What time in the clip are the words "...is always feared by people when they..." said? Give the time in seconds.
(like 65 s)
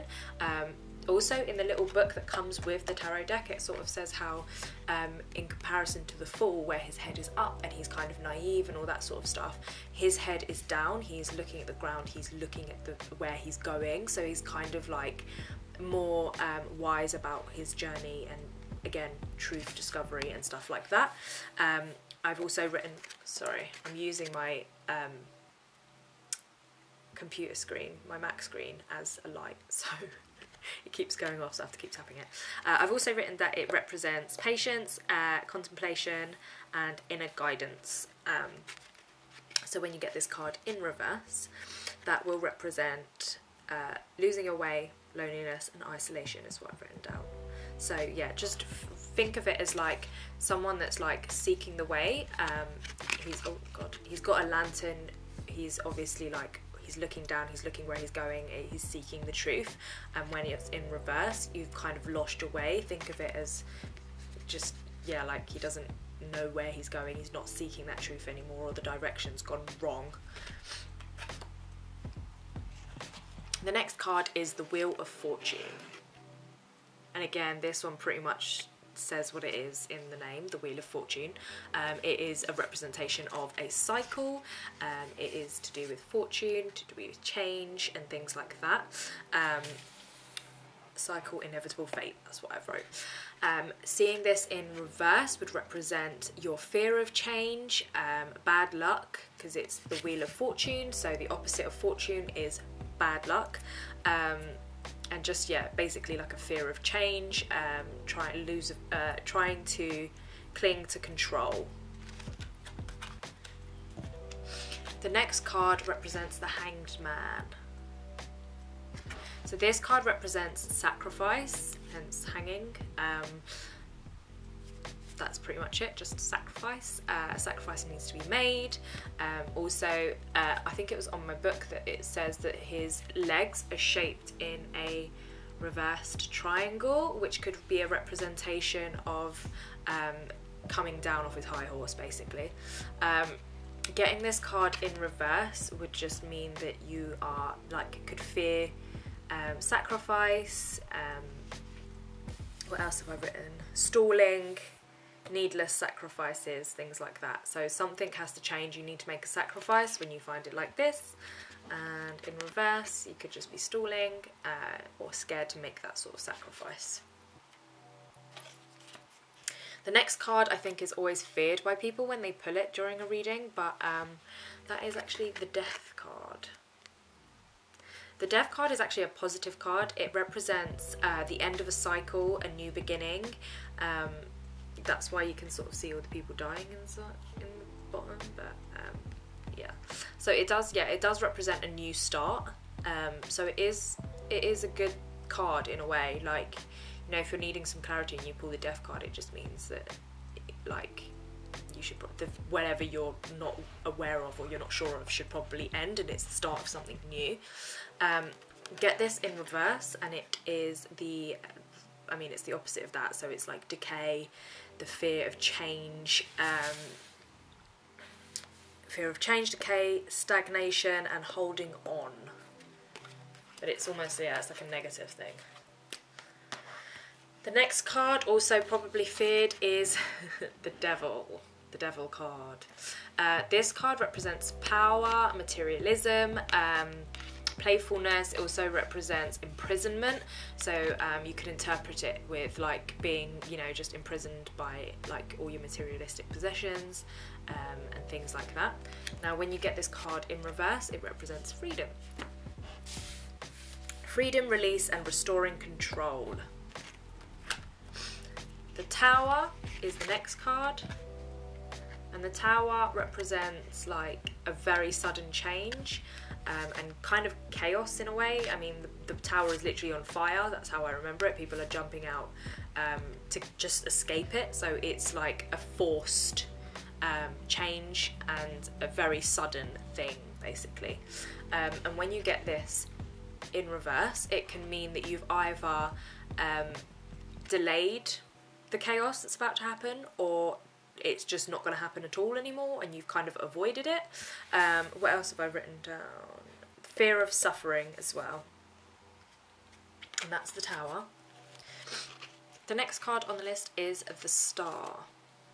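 170 s.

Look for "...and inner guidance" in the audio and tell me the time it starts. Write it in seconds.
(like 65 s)
36 s.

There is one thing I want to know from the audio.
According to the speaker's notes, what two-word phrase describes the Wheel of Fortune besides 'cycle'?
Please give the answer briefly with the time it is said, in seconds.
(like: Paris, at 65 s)
inevitable fate, at 91 s.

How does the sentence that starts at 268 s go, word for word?
I mean, the, the, tower is literally on fire.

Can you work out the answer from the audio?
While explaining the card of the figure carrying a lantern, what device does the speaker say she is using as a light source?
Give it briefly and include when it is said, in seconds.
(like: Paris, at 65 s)
Mac screen, at 28 s.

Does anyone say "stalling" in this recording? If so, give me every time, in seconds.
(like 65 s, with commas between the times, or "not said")
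153 s, 163 s.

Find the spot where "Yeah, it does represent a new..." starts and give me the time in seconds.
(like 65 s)
190 s.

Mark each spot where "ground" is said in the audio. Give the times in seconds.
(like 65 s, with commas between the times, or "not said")
11 s.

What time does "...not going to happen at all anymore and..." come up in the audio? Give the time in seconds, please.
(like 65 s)
291 s.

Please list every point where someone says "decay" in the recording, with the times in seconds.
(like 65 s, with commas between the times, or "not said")
213 s, 219 s.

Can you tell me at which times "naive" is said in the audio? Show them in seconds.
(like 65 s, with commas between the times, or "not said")
8 s.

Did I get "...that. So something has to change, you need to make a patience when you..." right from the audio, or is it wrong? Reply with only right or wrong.
wrong.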